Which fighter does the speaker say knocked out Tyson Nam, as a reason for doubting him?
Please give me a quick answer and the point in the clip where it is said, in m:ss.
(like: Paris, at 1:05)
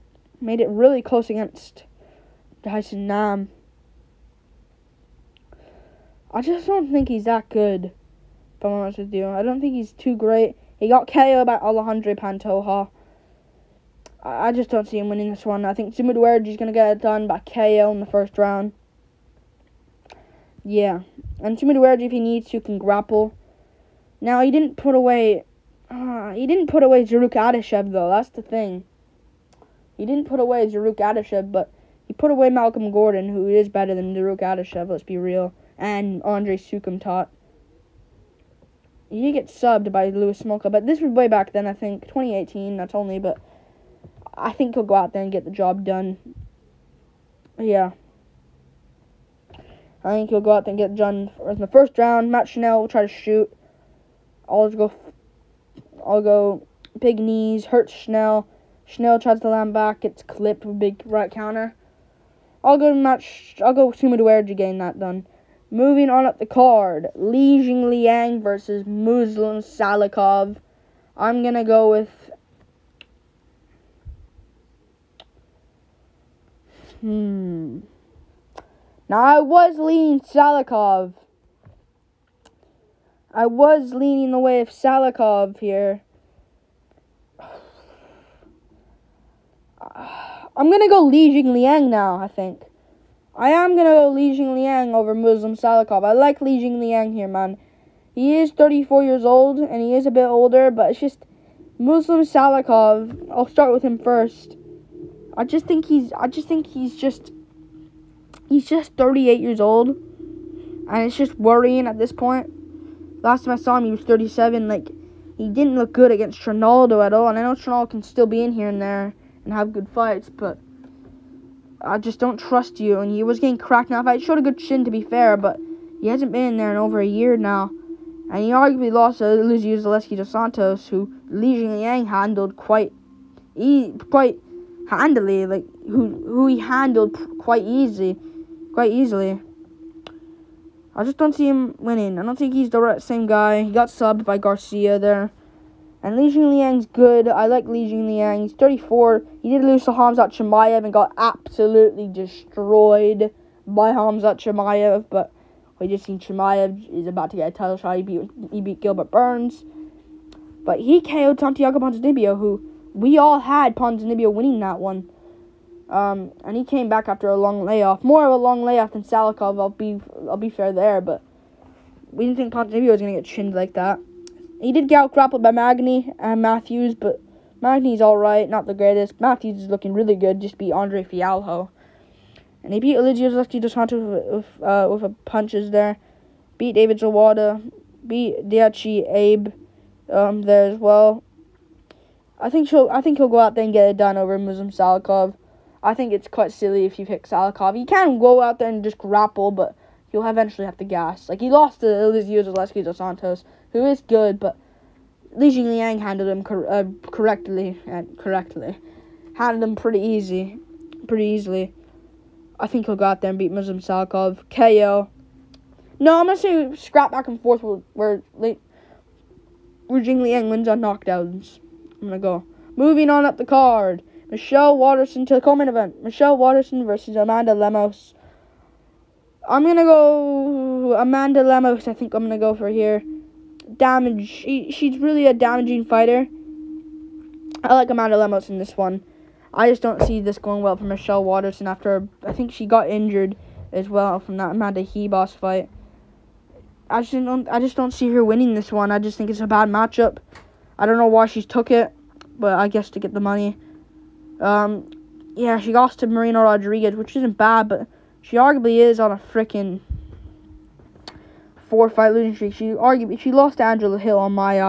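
Alexandre Pantoja, at 0:11.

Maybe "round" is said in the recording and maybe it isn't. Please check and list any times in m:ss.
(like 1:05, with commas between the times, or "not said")
0:18, 0:51.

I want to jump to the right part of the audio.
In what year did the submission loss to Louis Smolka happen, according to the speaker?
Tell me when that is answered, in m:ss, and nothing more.
0:42.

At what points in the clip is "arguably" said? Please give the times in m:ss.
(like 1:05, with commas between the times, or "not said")
2:08, 4:18, 4:22.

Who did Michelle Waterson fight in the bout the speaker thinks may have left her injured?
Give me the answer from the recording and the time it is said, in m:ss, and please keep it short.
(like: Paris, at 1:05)
Amanda Ribas, at 4:04.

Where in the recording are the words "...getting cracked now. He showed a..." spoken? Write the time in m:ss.
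2:03.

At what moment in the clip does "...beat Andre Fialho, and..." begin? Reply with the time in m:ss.
3:00.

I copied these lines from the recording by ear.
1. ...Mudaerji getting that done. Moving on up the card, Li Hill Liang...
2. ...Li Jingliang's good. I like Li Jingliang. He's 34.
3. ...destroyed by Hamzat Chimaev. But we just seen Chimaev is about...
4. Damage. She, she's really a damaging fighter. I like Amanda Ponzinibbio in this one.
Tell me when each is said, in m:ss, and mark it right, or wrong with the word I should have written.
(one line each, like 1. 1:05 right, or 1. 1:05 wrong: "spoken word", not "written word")
1. 1:04 wrong: "Jing", not "Hill"
2. 2:26 right
3. 2:32 right
4. 3:53 wrong: "Lemos", not "Ponzinibbio".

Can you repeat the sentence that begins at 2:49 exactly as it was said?
I'll be I'll be fair there, but we didn't think Ponzinibbio was gonna get chinned like that.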